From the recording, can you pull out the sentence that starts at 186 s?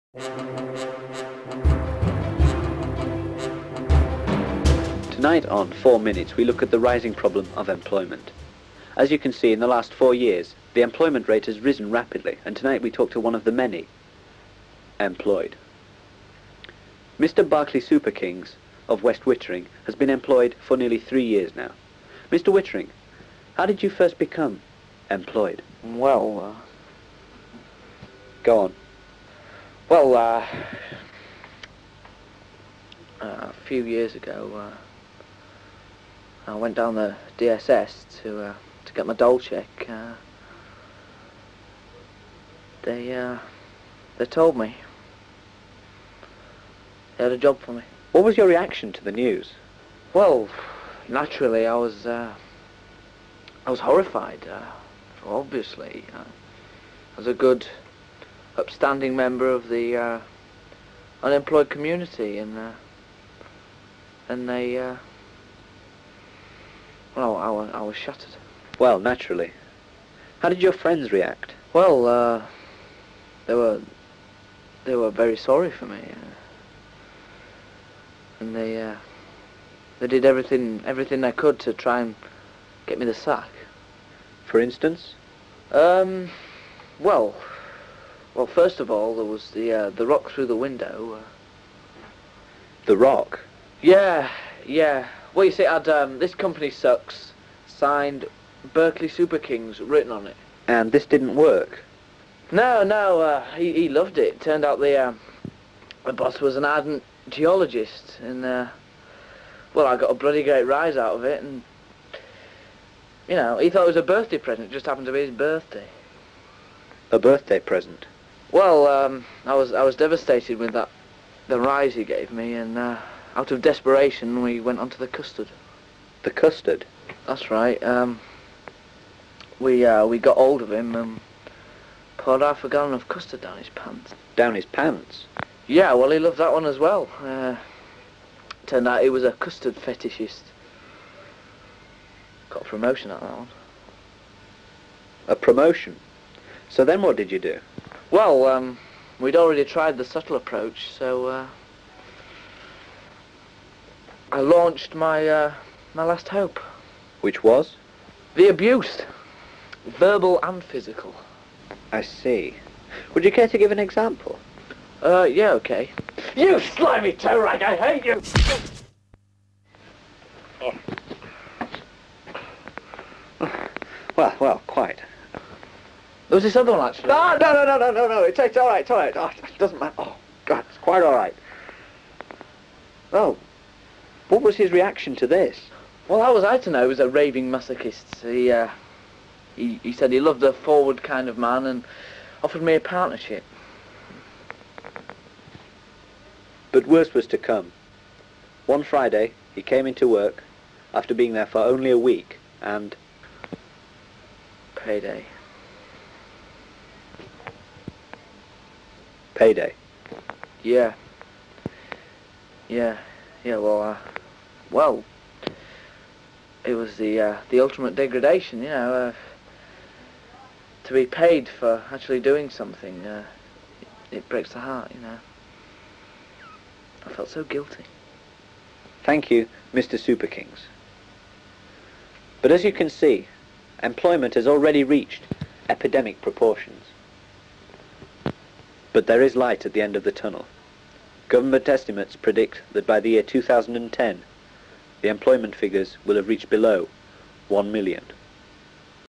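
Well, how was I to know?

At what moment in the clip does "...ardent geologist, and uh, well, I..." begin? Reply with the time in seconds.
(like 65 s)
106 s.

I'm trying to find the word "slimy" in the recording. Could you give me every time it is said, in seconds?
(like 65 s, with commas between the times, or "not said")
166 s.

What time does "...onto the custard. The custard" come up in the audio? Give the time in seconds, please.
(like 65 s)
124 s.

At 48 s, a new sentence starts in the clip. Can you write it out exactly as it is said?
What was your reaction to the news?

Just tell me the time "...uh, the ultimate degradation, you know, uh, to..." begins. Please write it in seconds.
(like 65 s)
217 s.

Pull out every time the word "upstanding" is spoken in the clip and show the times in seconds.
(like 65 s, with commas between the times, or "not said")
58 s.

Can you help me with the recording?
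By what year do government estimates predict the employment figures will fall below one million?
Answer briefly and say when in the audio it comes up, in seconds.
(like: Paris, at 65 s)
2010, at 243 s.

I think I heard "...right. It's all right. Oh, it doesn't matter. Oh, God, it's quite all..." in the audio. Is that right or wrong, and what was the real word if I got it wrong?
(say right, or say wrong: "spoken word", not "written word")
right.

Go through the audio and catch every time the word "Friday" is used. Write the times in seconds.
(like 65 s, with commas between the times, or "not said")
198 s.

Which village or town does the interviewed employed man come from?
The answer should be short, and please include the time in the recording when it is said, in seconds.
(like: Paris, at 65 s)
West Wittering, at 19 s.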